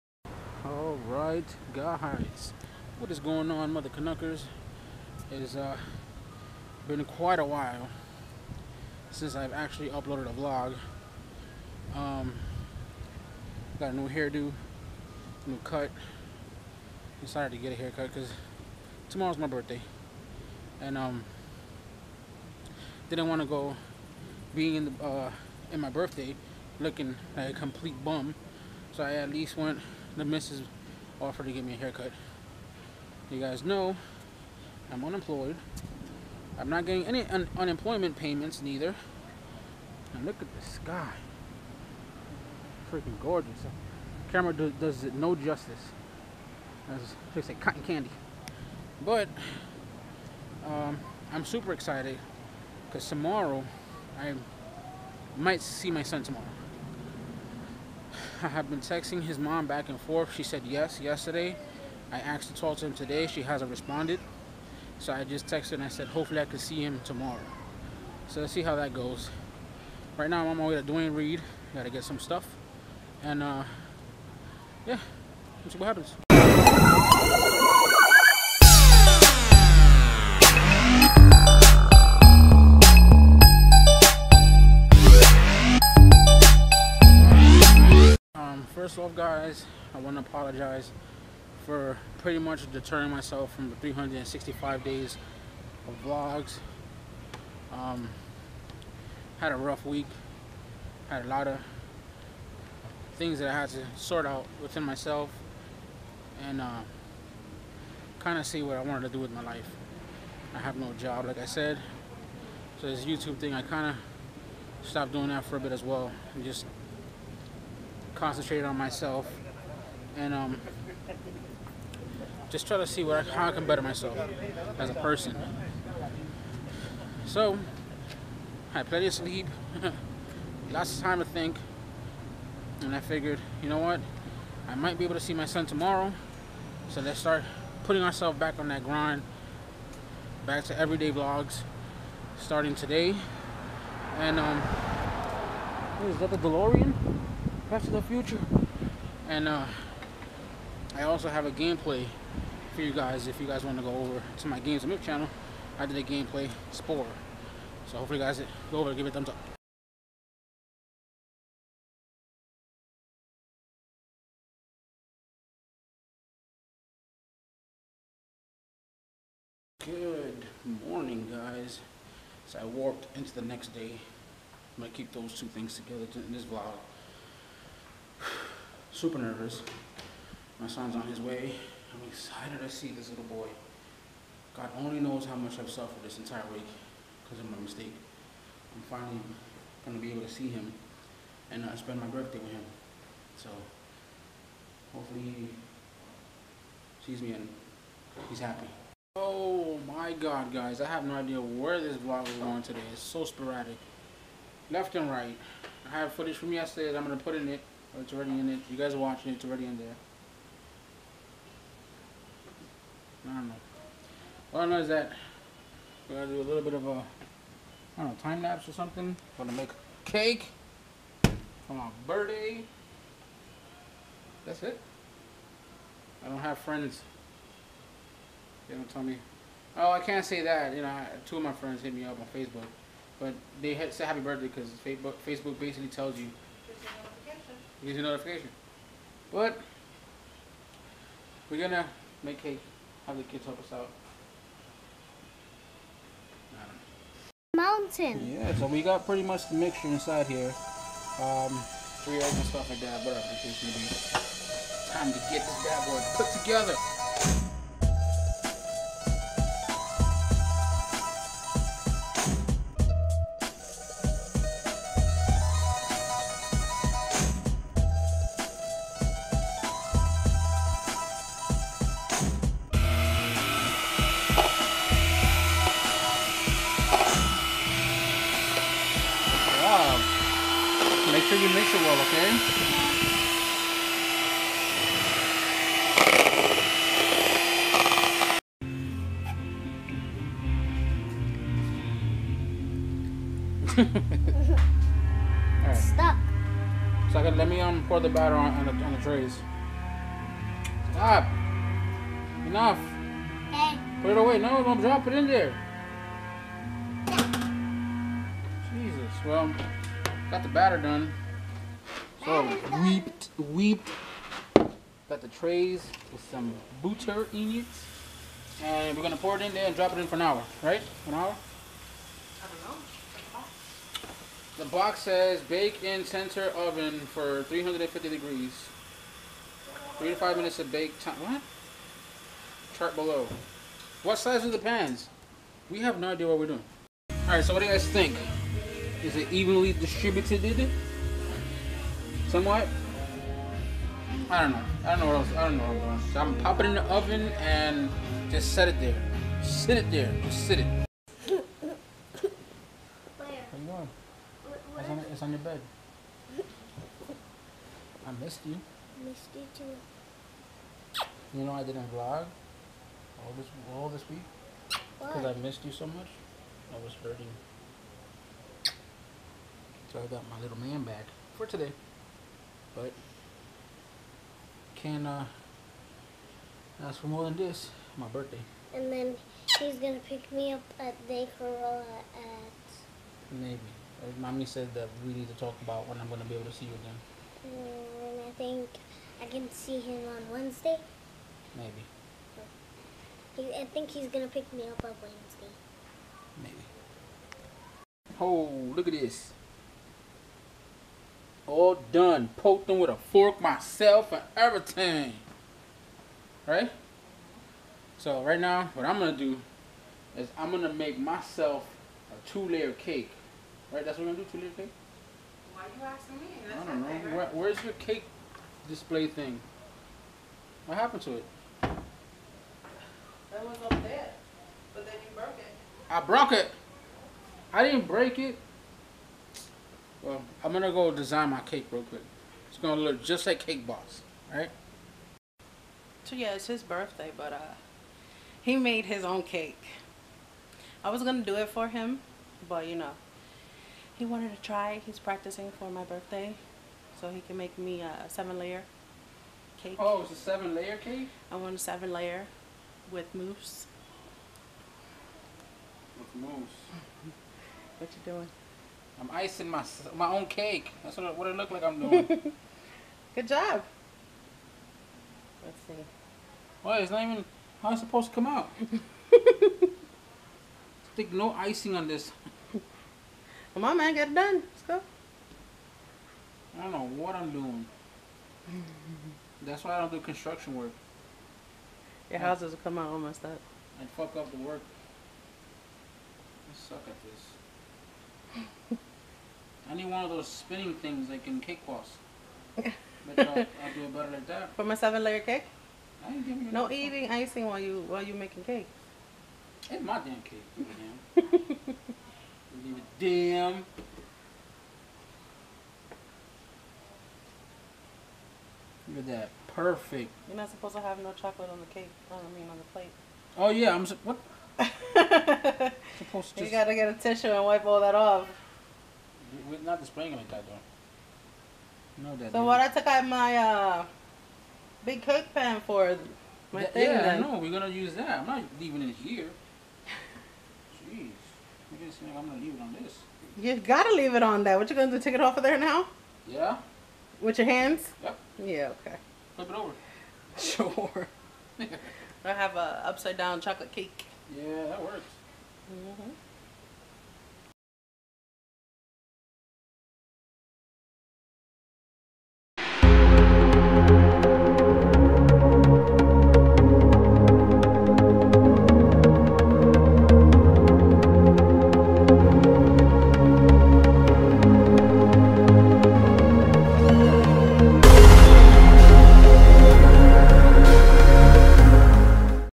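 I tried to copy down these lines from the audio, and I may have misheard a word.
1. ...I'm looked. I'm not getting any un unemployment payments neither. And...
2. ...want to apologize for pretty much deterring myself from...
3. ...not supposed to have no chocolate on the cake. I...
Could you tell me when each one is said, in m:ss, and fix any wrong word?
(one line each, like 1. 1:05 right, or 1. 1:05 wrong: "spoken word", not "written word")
1. 0:34 wrong: "unemployed", not "looked"
2. 1:29 right
3. 8:30 right.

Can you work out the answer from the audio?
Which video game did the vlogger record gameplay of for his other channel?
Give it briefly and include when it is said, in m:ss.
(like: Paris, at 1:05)
Spore, at 2:36.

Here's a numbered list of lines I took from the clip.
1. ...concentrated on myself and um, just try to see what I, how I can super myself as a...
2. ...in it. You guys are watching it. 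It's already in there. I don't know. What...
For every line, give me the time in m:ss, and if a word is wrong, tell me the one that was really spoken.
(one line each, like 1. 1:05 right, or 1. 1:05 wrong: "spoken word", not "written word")
1. 1:58 wrong: "better", not "super"
2. 3:28 right.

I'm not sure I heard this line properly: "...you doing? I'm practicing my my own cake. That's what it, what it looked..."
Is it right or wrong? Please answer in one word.
wrong.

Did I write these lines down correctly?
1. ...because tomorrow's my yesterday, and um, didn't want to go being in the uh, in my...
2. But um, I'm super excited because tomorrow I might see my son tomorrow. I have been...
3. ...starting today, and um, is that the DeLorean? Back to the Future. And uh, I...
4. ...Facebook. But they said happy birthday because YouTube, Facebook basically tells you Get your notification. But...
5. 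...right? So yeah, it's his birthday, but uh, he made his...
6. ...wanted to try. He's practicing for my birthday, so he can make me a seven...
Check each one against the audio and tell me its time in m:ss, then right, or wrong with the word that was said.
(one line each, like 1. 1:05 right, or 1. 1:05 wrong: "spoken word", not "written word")
1. 0:18 wrong: "birthday", not "yesterday"
2. 0:49 right
3. 2:22 right
4. 3:52 wrong: "Facebook", not "YouTube"
5. 7:14 right
6. 7:24 right.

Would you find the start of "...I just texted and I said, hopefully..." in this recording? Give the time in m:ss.
1:05.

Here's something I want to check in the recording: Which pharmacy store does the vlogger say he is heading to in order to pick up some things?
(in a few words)
Duane Reade.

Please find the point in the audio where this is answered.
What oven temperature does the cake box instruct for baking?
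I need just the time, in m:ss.
5:27.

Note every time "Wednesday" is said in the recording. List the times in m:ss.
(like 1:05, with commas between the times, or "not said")
6:30, 6:35.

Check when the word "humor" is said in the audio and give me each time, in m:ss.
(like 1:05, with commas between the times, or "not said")
not said.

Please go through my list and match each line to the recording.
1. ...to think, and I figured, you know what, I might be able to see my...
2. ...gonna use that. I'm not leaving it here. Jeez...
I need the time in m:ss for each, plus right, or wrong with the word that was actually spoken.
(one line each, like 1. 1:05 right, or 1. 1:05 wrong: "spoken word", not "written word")
1. 2:11 right
2. 8:47 right.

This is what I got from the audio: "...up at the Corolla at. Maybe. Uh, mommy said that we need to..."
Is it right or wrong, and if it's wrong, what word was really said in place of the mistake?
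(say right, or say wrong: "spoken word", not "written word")
right.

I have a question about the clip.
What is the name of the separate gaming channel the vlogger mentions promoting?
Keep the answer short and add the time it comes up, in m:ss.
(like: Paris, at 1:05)
Games of Myth, at 2:34.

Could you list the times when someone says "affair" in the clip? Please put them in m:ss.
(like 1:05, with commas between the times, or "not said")
not said.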